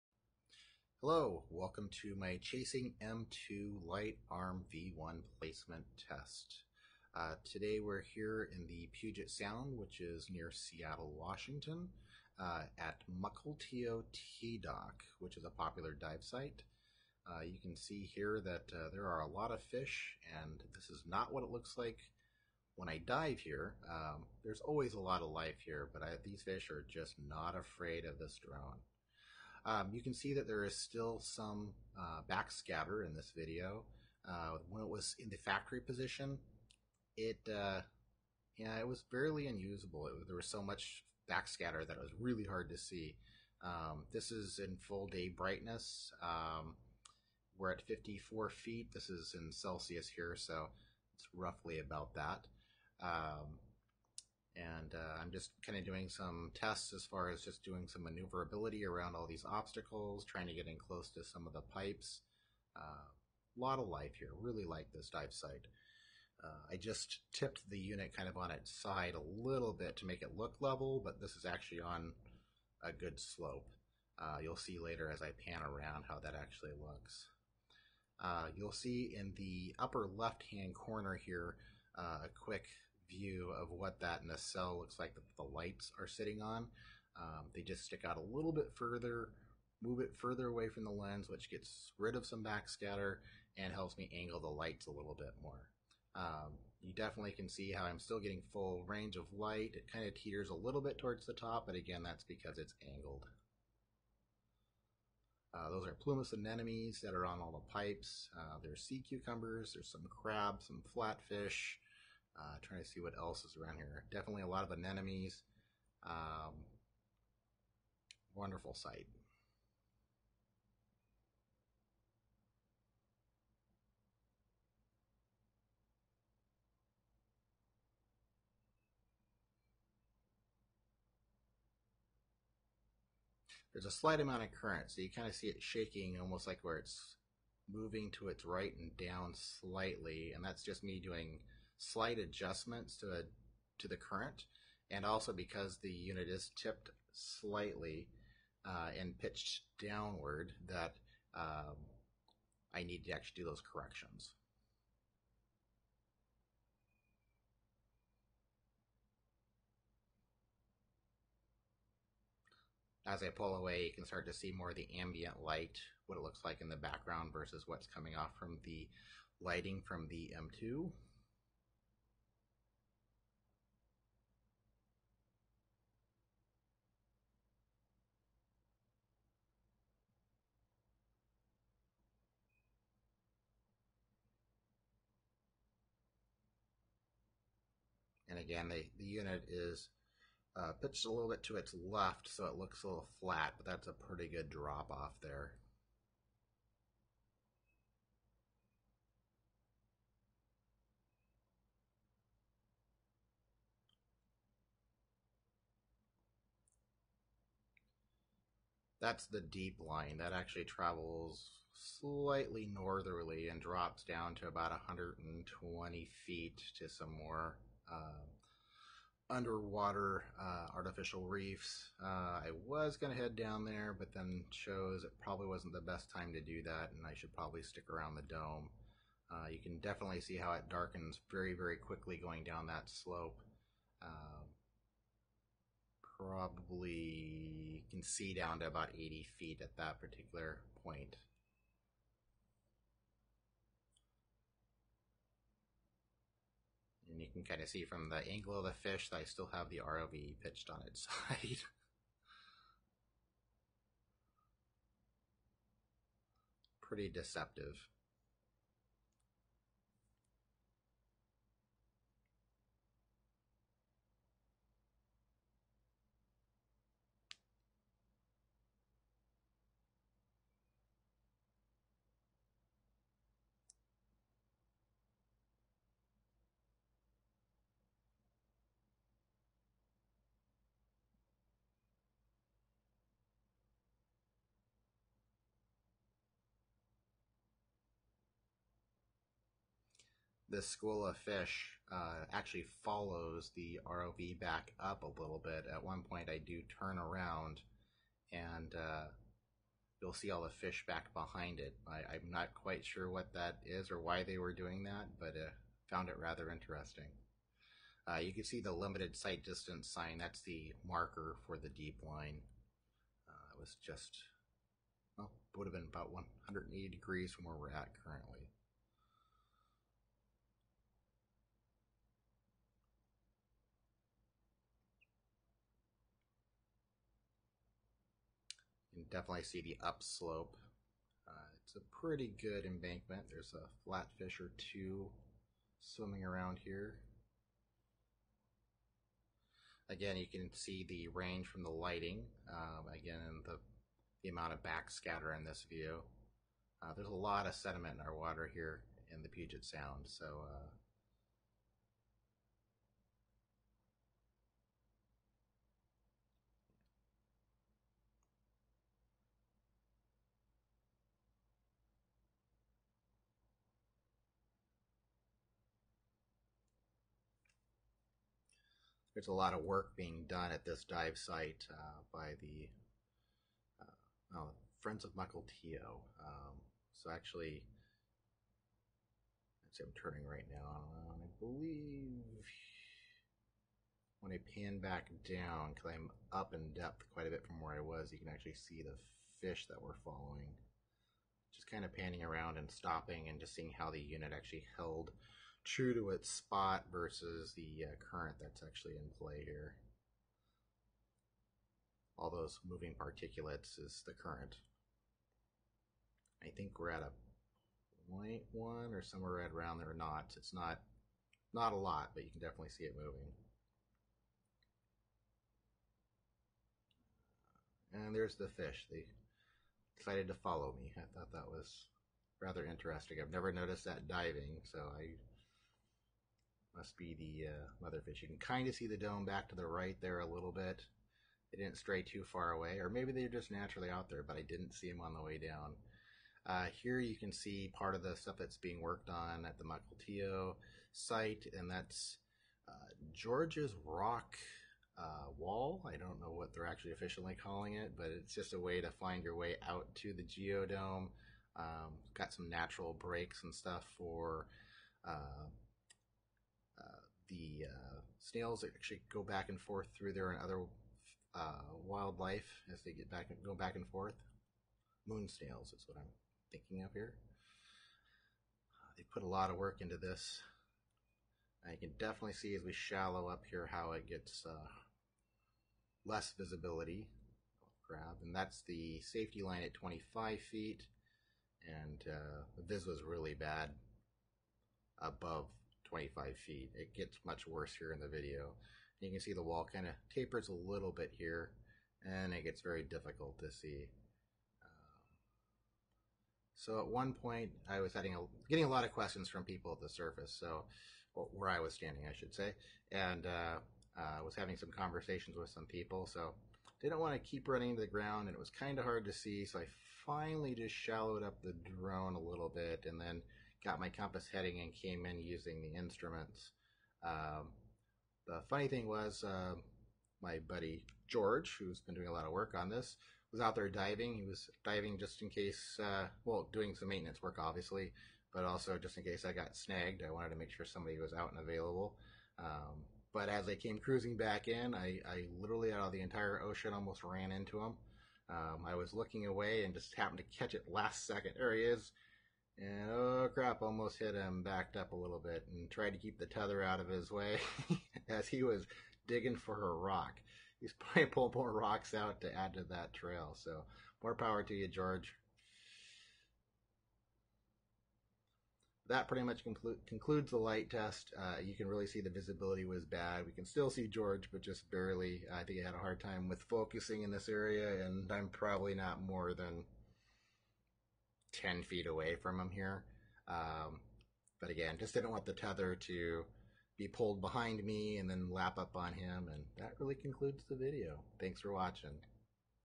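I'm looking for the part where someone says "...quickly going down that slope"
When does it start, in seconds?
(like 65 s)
231 s.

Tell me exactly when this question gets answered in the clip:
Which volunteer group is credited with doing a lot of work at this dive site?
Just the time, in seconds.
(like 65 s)
374 s.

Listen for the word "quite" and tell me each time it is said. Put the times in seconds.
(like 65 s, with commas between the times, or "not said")
302 s, 387 s.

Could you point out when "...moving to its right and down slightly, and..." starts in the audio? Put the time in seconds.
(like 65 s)
137 s.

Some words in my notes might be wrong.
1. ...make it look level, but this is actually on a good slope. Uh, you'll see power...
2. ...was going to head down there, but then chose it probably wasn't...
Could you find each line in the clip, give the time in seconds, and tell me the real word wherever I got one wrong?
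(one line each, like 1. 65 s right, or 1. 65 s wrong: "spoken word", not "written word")
1. 70 s wrong: "later", not "power"
2. 222 s right.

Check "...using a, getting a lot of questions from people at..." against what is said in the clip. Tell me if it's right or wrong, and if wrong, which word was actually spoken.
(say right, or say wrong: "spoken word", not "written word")
wrong: "having", not "using".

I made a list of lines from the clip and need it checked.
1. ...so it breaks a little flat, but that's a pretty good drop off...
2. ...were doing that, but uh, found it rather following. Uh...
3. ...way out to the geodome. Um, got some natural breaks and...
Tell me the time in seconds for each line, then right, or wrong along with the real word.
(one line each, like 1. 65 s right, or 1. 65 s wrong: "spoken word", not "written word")
1. 192 s wrong: "looks", not "breaks"
2. 304 s wrong: "interesting", not "following"
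3. 449 s right.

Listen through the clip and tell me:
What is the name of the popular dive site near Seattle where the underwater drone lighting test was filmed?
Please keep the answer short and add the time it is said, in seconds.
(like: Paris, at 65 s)
Mukilteo T Dock, at 13 s.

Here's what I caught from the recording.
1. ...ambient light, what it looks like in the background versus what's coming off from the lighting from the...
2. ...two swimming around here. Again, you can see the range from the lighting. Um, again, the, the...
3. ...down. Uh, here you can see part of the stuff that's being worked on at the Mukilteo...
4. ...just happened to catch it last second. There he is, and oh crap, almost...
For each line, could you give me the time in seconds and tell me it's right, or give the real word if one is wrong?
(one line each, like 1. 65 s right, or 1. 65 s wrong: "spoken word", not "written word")
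1. 164 s right
2. 334 s right
3. 435 s right
4. 539 s right.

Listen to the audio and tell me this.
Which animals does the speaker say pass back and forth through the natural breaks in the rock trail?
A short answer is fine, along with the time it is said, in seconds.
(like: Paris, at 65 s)
Moon snails, at 465 s.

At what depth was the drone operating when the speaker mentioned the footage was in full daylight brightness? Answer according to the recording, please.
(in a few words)
54 feet.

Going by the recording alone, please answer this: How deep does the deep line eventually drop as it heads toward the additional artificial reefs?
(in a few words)
120 feet.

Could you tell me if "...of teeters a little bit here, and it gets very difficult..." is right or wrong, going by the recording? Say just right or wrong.
wrong.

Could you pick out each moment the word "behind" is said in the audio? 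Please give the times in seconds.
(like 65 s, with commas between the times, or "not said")
301 s, 577 s.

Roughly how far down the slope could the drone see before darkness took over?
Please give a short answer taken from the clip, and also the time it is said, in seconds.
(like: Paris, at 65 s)
80 feet, at 238 s.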